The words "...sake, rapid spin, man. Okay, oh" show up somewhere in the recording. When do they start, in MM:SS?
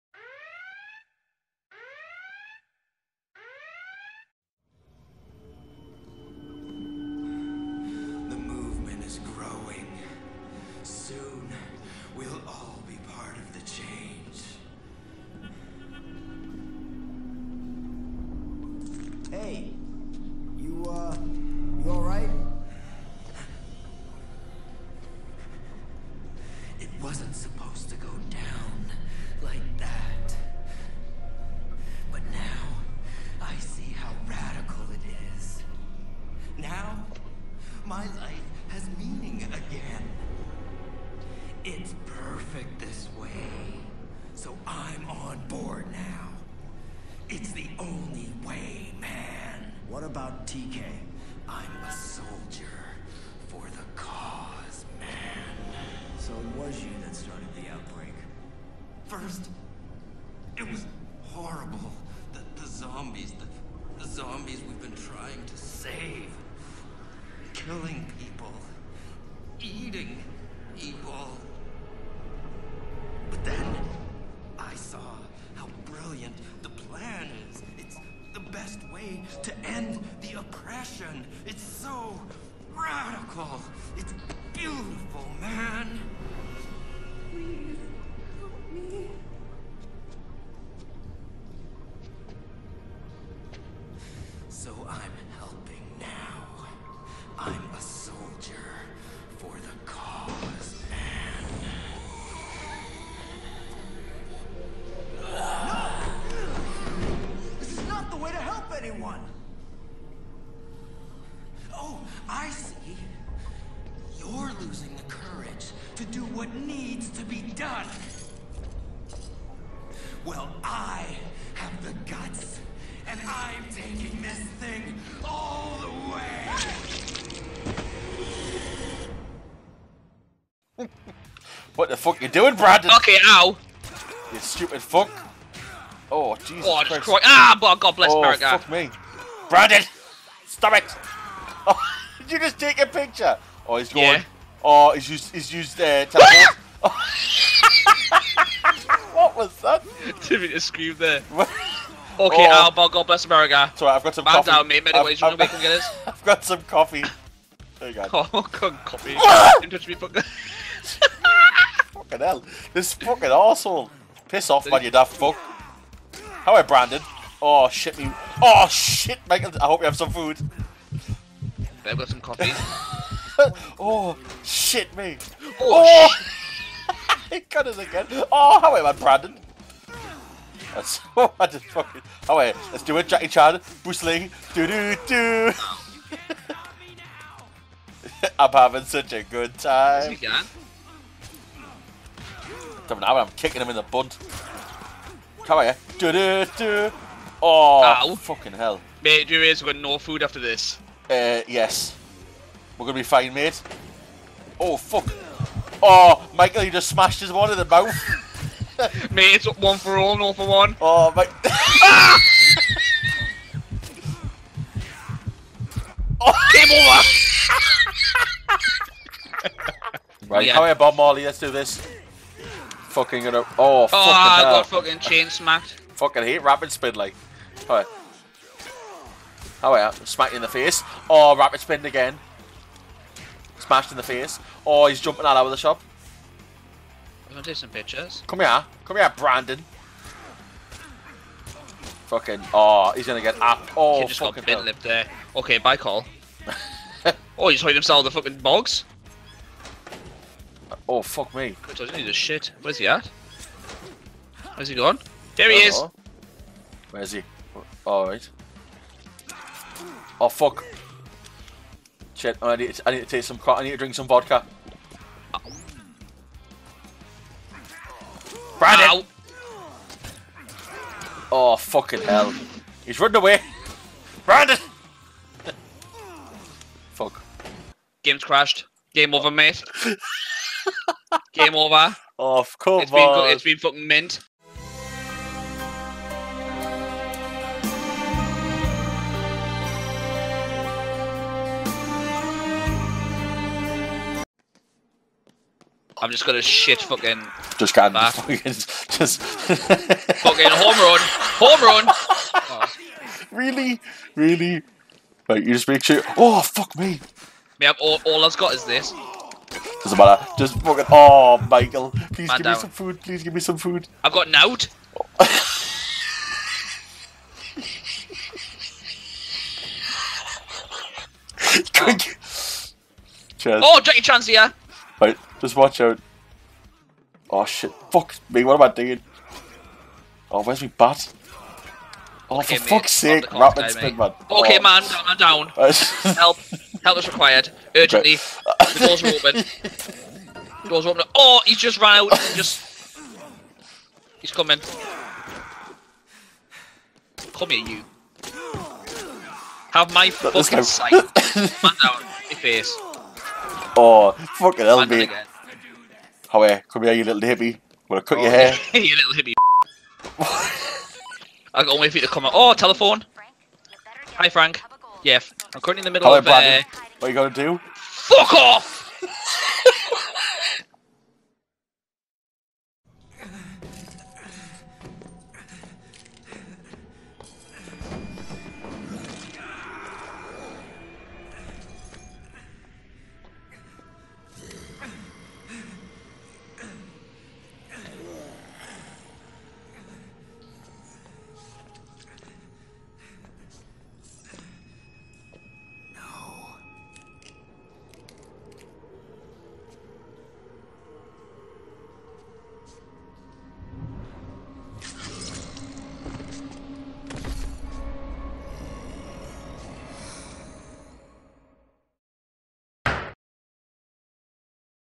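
05:32.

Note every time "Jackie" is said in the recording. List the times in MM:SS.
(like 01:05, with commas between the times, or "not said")
03:03, 05:23.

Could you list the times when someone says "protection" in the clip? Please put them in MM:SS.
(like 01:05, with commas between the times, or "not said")
not said.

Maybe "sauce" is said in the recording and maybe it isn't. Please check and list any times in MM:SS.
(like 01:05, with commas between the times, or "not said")
not said.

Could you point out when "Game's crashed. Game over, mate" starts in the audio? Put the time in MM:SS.
04:38.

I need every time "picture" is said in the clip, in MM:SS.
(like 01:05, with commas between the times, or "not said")
02:22, 03:57.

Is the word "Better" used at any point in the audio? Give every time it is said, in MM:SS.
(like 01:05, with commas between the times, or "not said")
02:51.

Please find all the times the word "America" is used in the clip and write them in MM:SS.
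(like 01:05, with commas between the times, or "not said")
02:18, 02:33.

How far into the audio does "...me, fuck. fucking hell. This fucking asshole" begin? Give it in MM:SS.
02:39.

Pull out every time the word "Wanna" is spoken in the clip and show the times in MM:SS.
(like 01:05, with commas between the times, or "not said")
05:57.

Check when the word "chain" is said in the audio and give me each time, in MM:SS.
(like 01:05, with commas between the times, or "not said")
03:44.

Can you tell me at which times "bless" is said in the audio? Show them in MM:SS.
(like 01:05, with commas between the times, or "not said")
02:17, 02:33.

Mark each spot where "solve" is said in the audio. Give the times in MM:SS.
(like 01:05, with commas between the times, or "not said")
not said.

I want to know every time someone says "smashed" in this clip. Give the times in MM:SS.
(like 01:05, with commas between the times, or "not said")
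03:26, 03:53.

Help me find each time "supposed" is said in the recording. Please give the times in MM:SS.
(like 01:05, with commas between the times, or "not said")
00:27.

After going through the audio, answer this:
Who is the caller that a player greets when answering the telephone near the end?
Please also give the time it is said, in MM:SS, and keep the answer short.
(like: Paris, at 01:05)
Frank, at 06:04.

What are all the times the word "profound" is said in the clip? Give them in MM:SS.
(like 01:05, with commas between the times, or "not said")
not said.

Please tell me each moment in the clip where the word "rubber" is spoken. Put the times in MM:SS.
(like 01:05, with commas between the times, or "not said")
not said.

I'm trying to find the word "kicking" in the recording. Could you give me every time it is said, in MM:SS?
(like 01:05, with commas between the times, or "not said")
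03:13.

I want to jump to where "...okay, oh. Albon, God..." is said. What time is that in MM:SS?
02:31.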